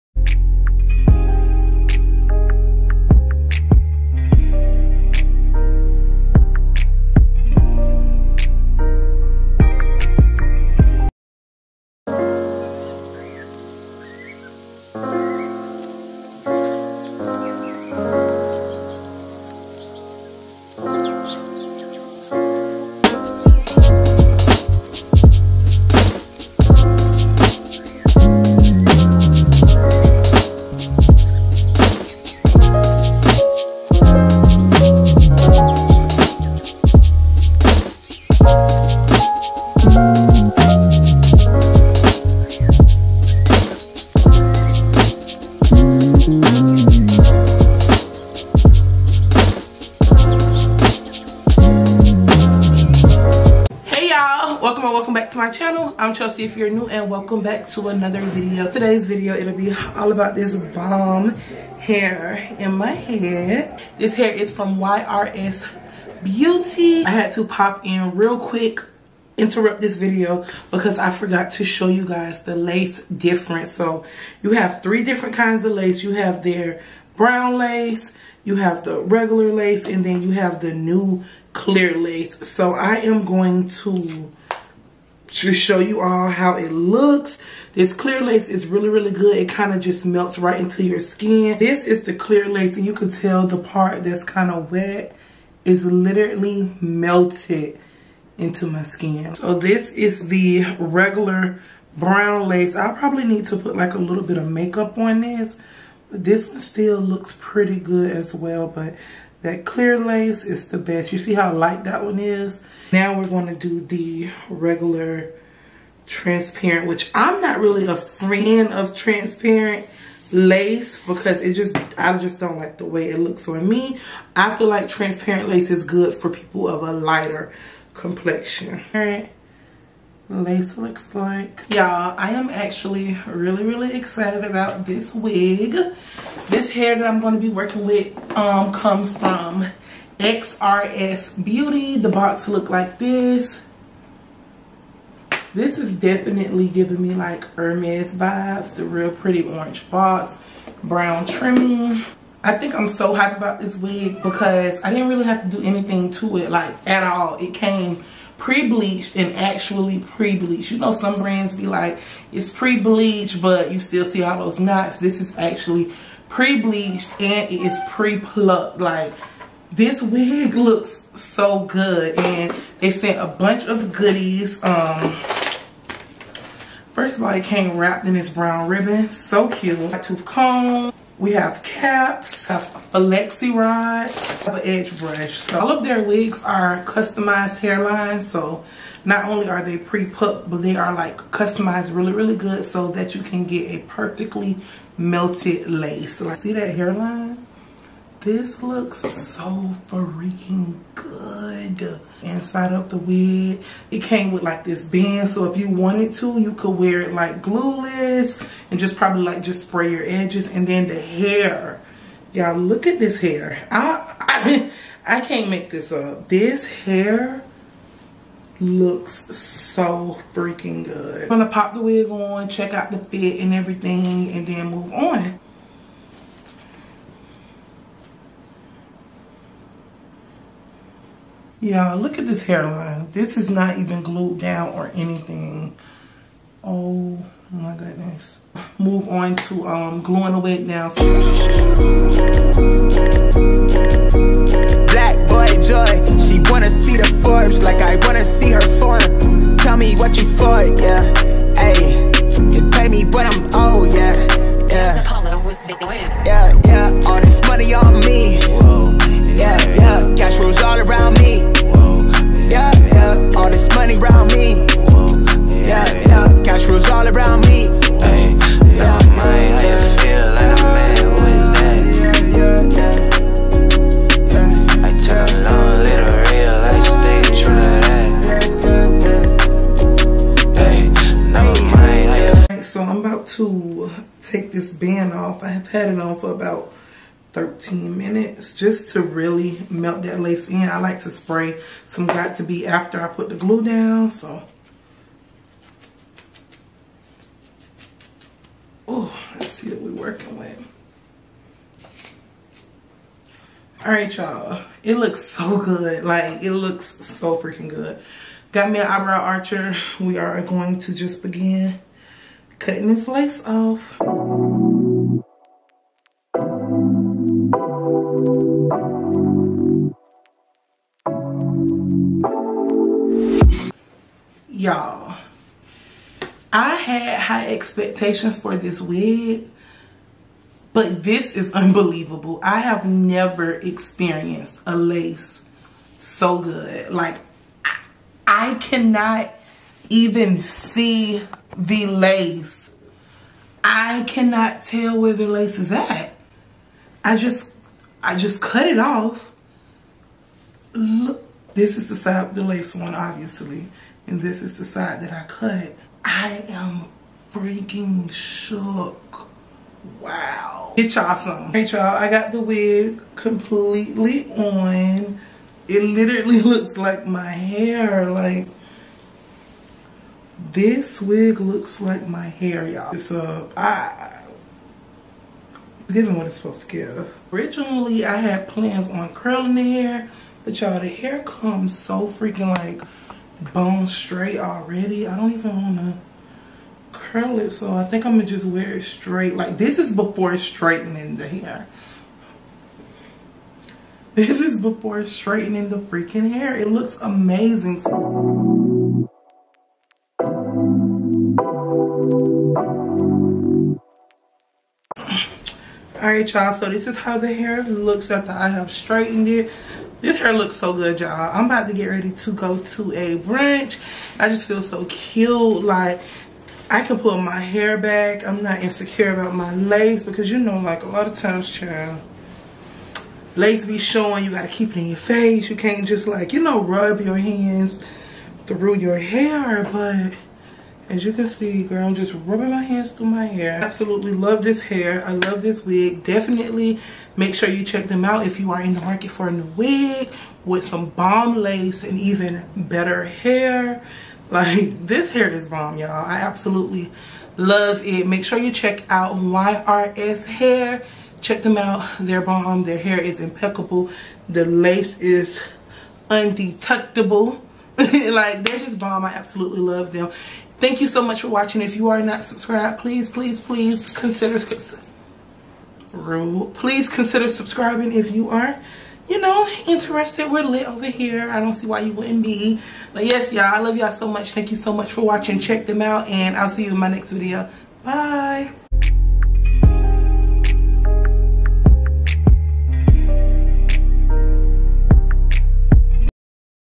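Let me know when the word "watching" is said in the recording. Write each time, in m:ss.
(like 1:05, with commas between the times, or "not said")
7:41, 7:55.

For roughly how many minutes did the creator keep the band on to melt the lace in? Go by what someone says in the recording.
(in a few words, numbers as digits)
13.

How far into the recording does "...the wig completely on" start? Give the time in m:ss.
6:02.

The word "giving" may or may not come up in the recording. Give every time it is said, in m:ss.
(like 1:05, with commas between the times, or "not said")
2:26, 6:15.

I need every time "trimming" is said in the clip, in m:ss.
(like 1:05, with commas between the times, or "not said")
2:31.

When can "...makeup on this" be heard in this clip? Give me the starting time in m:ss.
1:44.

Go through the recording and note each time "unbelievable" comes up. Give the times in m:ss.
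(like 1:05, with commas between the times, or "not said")
5:31.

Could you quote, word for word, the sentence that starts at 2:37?
It came pre-bleached and actually pre-bleached.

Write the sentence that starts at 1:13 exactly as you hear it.
So you have three different kinds of lace.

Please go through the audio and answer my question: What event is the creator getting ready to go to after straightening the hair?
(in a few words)
Brunch.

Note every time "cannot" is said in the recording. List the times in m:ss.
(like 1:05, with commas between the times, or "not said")
5:38, 5:44.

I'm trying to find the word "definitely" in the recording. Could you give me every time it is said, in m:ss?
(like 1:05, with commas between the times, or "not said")
2:25, 7:16.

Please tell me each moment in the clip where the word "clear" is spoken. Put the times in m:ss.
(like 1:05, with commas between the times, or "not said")
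1:21, 1:27, 1:32, 1:49.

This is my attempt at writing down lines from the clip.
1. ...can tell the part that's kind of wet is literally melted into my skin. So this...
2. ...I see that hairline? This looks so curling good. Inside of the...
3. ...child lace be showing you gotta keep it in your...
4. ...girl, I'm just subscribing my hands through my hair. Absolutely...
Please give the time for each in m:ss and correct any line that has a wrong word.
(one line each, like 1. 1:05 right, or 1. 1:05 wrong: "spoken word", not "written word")
1. 1:32 right
2. 3:16 wrong: "freaking", not "curling"
3. 7:01 right
4. 7:11 wrong: "rubbing", not "subscribing".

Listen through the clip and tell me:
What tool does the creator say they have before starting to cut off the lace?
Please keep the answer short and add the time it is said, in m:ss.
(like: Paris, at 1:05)
Eyebrow archer, at 5:08.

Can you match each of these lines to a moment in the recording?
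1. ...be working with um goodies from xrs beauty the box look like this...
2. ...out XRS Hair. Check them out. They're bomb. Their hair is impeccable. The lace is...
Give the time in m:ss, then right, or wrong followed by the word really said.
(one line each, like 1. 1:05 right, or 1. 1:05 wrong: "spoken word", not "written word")
1. 2:17 wrong: "comes", not "goodies"
2. 7:28 right.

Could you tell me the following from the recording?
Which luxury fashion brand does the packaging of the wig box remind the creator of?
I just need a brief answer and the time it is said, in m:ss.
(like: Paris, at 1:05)
Hermes, at 2:27.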